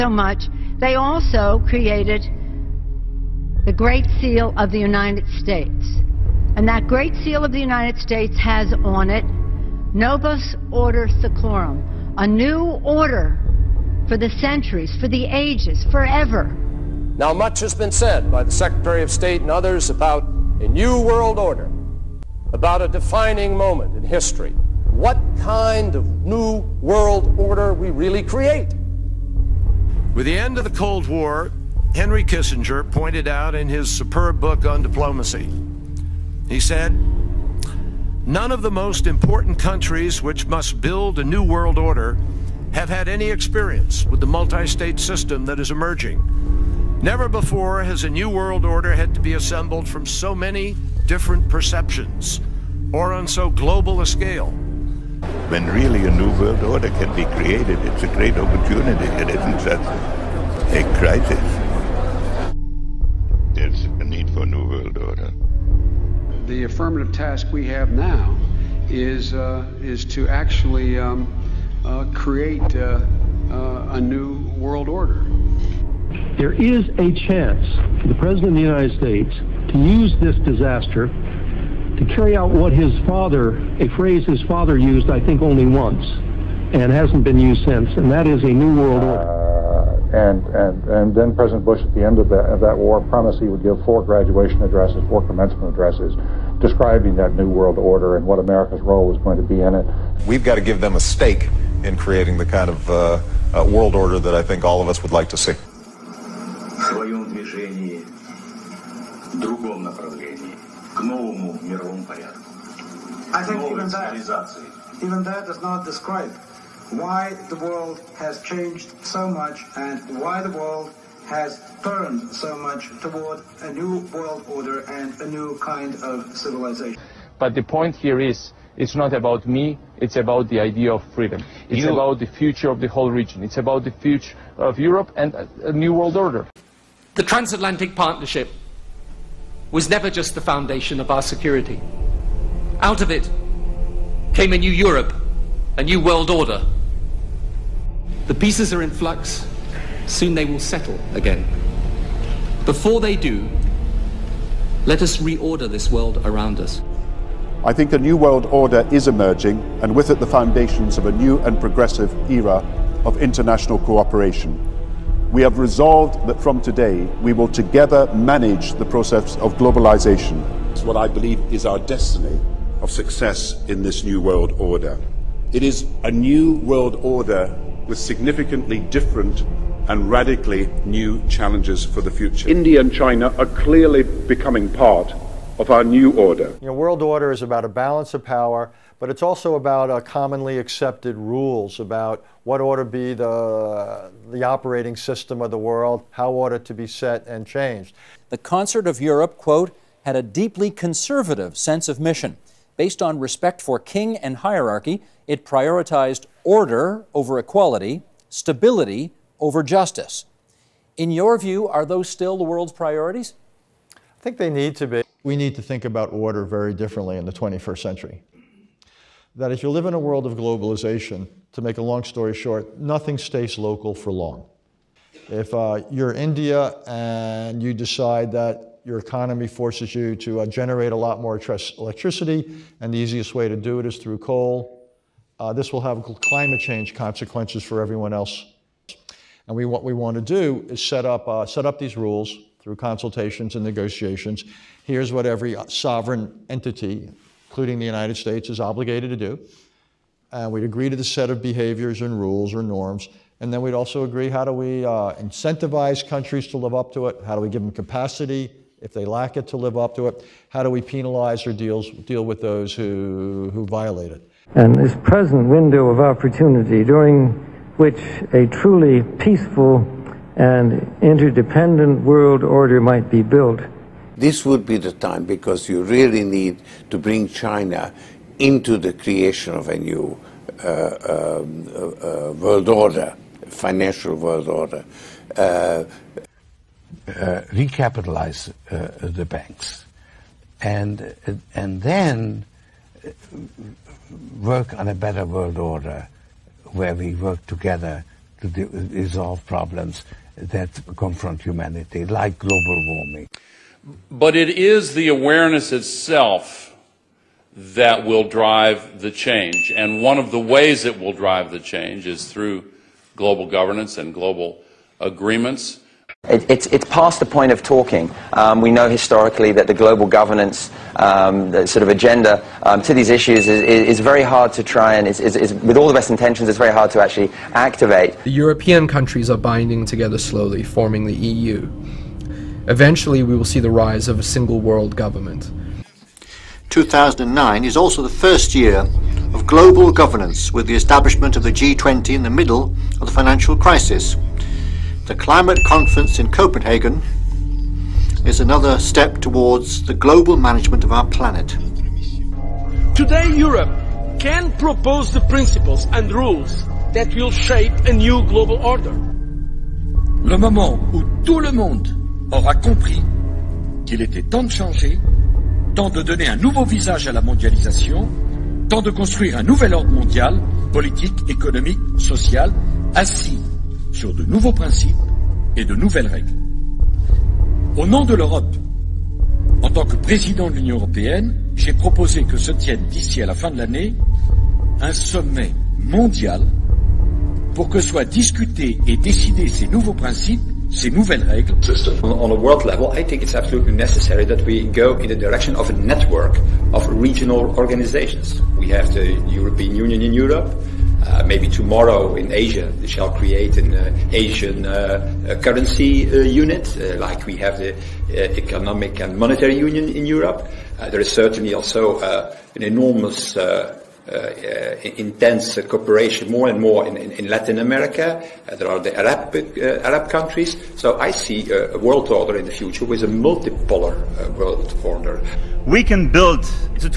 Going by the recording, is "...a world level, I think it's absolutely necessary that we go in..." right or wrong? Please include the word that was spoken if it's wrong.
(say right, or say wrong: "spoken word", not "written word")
right.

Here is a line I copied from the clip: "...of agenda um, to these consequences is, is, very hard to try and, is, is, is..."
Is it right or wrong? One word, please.
wrong.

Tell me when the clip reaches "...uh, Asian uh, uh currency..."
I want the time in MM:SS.
06:43.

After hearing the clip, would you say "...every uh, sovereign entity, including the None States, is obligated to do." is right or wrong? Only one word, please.
wrong.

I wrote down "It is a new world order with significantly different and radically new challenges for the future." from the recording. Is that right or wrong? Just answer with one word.
right.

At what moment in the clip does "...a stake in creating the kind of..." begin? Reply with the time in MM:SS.
01:40.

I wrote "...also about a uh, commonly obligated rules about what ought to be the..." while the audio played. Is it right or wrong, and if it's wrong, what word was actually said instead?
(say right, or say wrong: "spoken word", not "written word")
wrong: "accepted", not "obligated".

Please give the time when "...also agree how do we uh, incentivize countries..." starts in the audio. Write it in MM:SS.
04:13.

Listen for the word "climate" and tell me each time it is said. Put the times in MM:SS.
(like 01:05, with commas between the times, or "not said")
03:56, 05:45.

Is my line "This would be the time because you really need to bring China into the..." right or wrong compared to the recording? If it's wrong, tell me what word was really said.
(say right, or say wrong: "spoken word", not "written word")
right.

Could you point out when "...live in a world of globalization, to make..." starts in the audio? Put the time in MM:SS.
03:39.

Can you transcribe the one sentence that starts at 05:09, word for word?
And one of the ways it will drive the change is through global governance and global agreements.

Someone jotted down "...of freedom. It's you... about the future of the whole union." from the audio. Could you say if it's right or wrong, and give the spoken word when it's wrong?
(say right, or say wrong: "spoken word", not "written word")
wrong: "region", not "union".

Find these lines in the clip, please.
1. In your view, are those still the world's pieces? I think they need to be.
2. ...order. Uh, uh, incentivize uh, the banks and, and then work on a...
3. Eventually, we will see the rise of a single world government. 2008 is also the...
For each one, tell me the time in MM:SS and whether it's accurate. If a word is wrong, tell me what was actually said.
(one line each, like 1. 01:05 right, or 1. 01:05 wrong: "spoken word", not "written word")
1. 03:30 wrong: "priorities", not "pieces"
2. 04:44 wrong: "recapitalize", not "incentivize"
3. 05:32 wrong: "2009", not "2008".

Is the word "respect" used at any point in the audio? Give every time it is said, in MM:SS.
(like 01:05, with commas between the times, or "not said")
03:23.